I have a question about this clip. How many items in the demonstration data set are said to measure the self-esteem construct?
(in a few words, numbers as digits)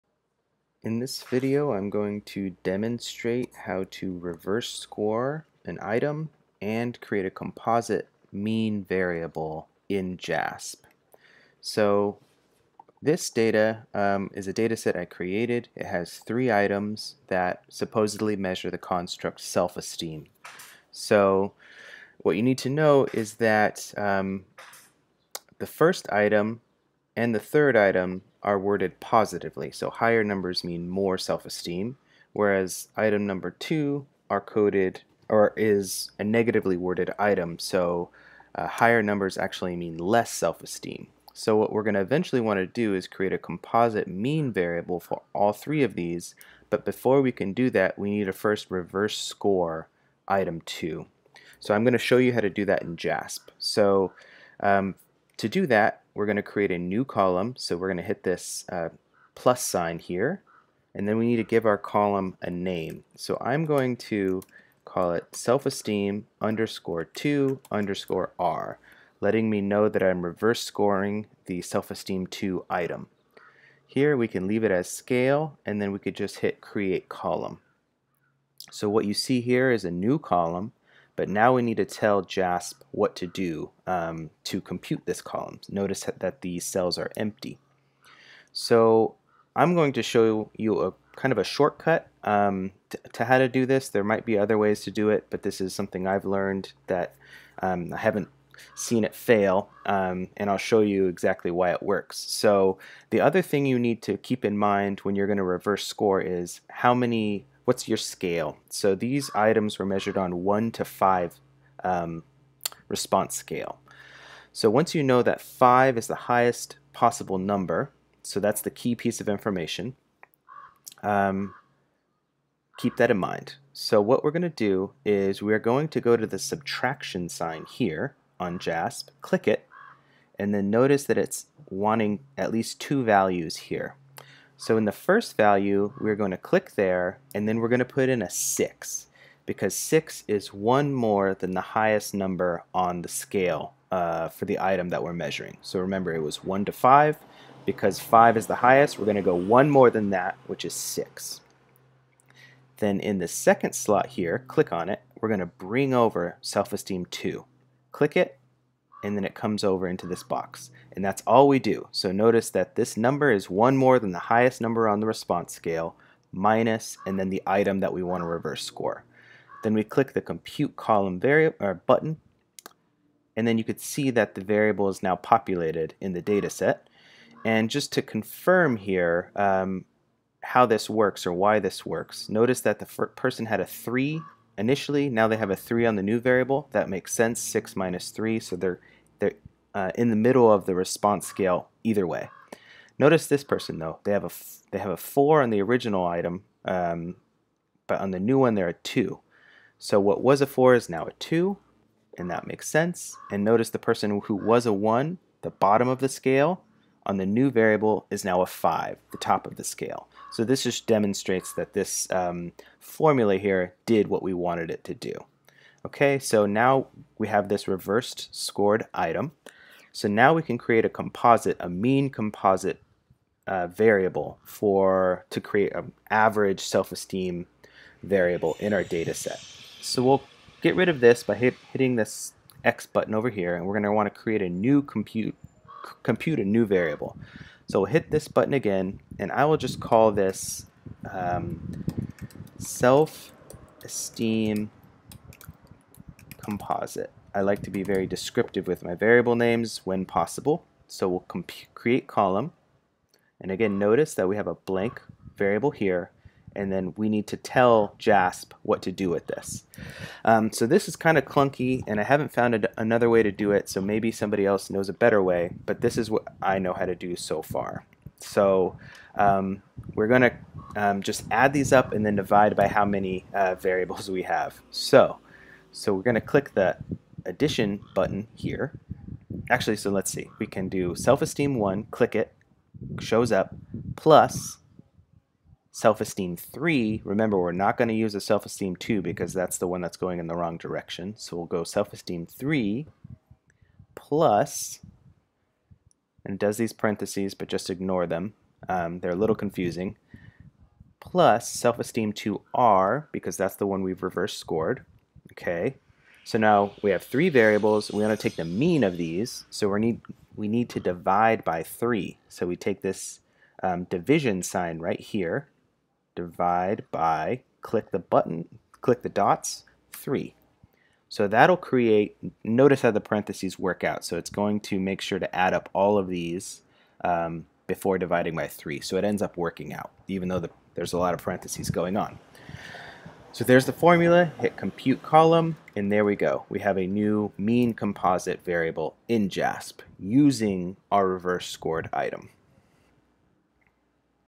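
3.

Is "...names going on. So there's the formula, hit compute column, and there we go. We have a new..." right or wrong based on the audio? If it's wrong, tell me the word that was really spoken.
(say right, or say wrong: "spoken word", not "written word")
wrong: "parentheses", not "names".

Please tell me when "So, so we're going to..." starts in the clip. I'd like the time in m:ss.
4:34.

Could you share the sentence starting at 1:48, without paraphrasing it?
So these items were measured on 1 to 5 um, response scale.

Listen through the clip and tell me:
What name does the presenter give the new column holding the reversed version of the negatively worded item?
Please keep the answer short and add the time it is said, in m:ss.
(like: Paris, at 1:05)
self-esteem_2_R, at 1:05.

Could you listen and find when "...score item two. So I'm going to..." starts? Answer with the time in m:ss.
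0:49.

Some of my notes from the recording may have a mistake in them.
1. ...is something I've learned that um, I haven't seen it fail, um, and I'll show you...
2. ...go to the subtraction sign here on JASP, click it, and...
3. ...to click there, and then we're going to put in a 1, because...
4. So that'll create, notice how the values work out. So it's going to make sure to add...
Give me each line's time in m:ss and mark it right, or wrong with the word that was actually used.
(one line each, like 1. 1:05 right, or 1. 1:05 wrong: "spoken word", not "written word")
1. 1:35 right
2. 2:06 right
3. 2:16 wrong: "6", not "1"
4. 5:21 wrong: "parentheses", not "values".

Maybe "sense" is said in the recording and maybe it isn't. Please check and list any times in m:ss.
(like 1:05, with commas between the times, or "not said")
3:07, 3:22.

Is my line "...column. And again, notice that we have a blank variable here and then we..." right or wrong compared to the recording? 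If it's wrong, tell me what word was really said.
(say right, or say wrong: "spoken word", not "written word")
right.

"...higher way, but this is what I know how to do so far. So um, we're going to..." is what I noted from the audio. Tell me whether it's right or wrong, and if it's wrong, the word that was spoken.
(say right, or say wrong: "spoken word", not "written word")
wrong: "better", not "higher".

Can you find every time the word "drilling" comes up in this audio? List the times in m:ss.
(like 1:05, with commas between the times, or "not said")
not said.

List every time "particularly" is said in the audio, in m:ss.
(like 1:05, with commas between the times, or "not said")
not said.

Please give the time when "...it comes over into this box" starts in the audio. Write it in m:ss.
2:39.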